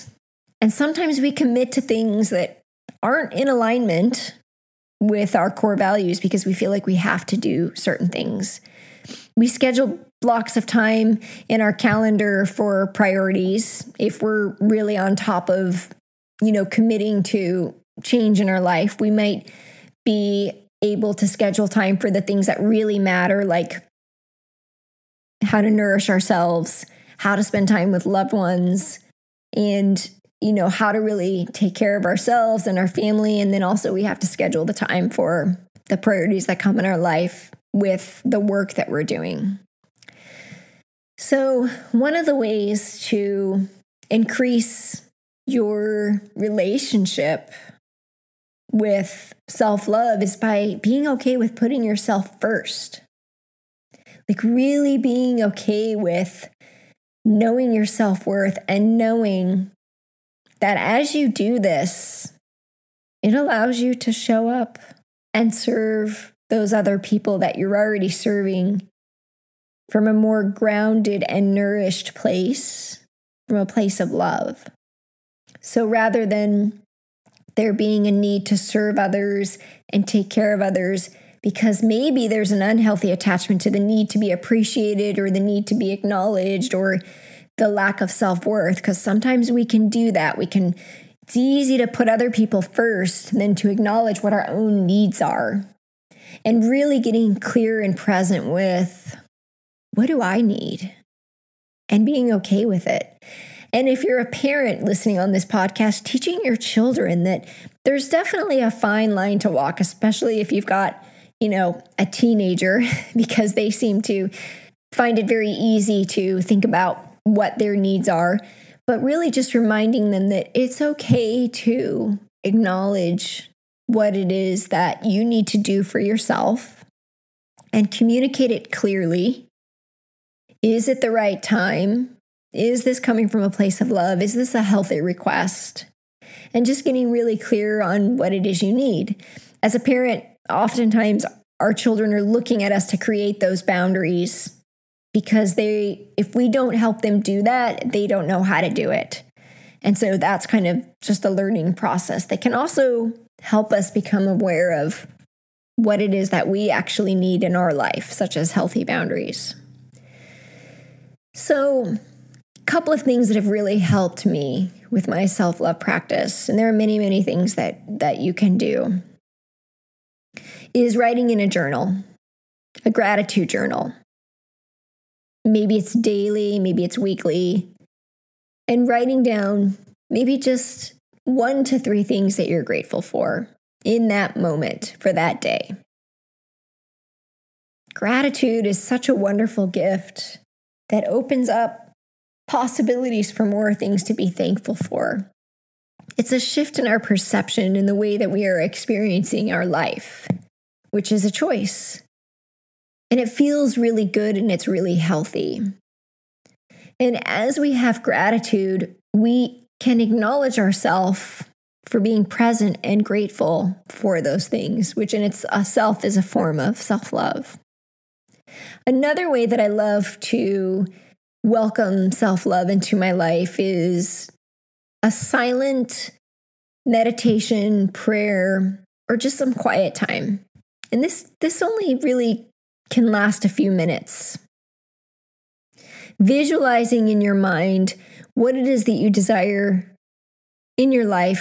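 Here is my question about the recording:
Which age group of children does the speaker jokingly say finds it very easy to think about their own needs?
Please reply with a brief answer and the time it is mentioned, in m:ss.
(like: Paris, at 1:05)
teenager, at 1:51.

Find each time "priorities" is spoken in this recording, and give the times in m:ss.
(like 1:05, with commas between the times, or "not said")
0:12, 0:35.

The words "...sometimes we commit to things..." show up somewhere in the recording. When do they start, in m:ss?
0:00.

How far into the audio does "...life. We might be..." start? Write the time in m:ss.
0:18.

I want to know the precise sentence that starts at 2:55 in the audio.
Maybe it's daily, maybe it's weekly.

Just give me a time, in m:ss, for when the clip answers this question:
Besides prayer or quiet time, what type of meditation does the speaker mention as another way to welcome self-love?
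3:45.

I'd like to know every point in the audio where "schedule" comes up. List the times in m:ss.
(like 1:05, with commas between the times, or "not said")
0:09, 0:21, 0:34.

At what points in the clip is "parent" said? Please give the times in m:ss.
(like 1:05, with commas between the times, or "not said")
1:44, 2:19.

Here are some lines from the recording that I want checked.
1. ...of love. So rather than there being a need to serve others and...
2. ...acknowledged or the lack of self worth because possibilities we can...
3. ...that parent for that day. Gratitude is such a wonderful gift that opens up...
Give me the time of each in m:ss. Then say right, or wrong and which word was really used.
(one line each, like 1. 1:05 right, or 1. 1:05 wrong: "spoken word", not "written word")
1. 1:13 right
2. 1:25 wrong: "sometimes", not "possibilities"
3. 3:04 wrong: "moment", not "parent".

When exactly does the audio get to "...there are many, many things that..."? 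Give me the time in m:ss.
2:46.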